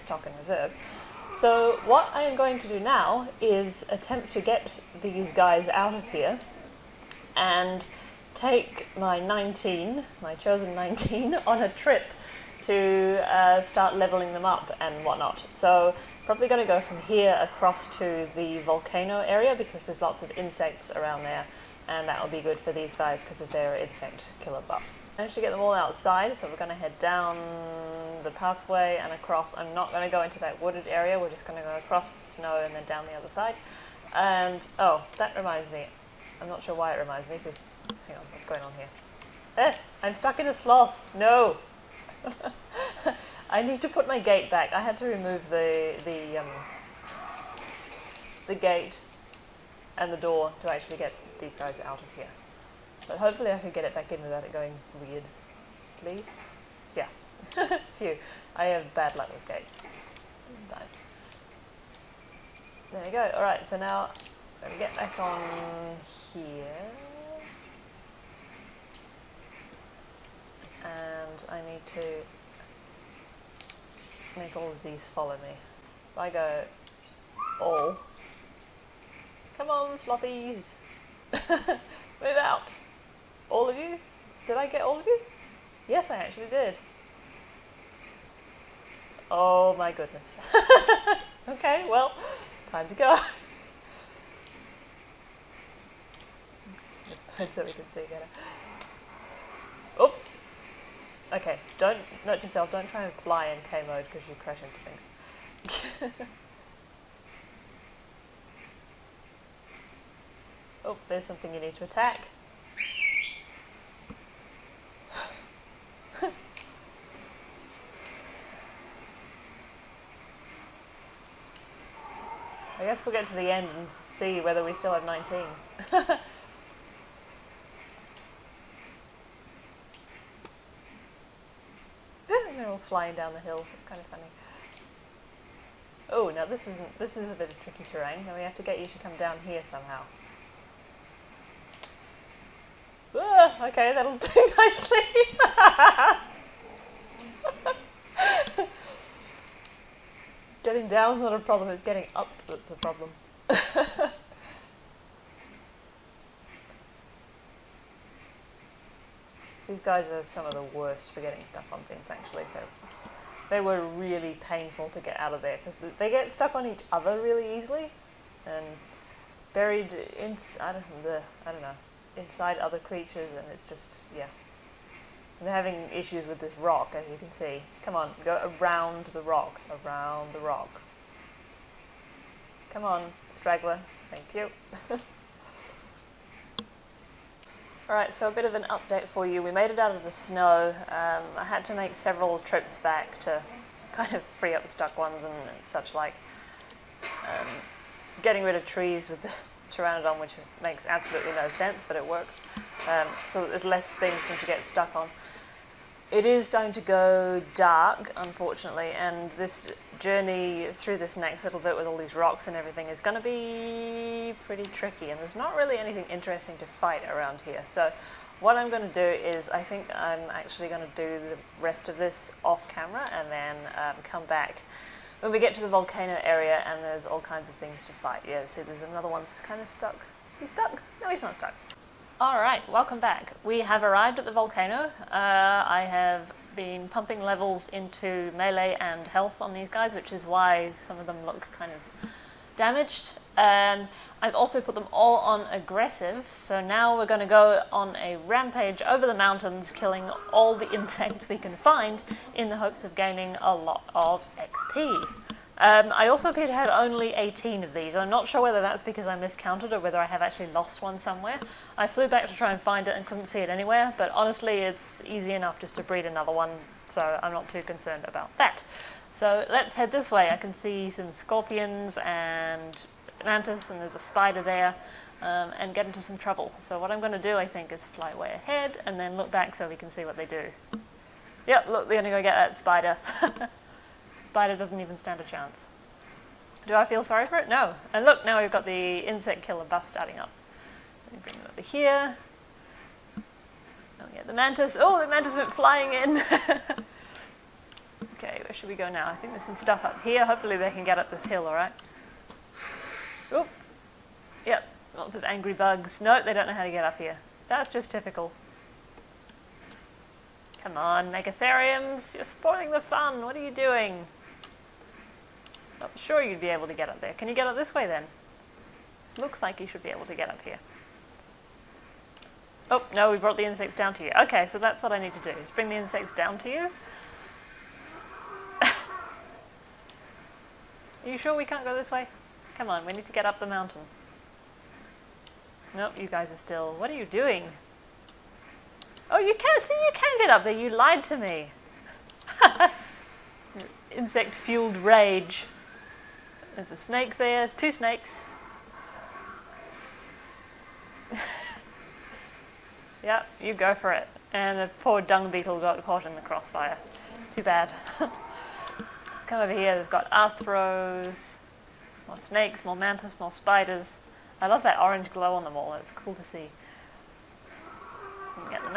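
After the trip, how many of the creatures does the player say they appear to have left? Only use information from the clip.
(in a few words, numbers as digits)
18.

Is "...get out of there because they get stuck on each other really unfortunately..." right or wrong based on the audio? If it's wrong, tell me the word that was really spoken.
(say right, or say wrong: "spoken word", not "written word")
wrong: "easily", not "unfortunately".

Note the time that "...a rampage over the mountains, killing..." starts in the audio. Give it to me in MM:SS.
04:07.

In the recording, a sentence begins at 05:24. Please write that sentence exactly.
Okay, so that's what I need to do, is bring the insects down to you.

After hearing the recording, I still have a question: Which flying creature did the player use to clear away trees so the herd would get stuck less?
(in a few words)
pteranodon.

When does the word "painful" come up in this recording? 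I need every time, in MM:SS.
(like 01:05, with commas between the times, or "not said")
02:44.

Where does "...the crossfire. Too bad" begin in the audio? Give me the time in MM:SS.
05:56.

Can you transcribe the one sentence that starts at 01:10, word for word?
And and I need to make all of these follow me.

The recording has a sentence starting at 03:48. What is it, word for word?
Yeah, see there's another that's kind of stuck.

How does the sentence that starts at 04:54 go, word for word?
Oh, the mantis went flying in.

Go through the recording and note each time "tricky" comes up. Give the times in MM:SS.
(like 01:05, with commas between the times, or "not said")
02:17, 03:34.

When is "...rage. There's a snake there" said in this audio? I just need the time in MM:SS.
05:44.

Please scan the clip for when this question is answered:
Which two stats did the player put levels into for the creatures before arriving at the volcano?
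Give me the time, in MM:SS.
03:58.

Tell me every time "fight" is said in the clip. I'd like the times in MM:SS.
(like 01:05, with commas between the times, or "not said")
03:36, 03:47.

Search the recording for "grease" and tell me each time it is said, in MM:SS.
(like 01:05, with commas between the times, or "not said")
not said.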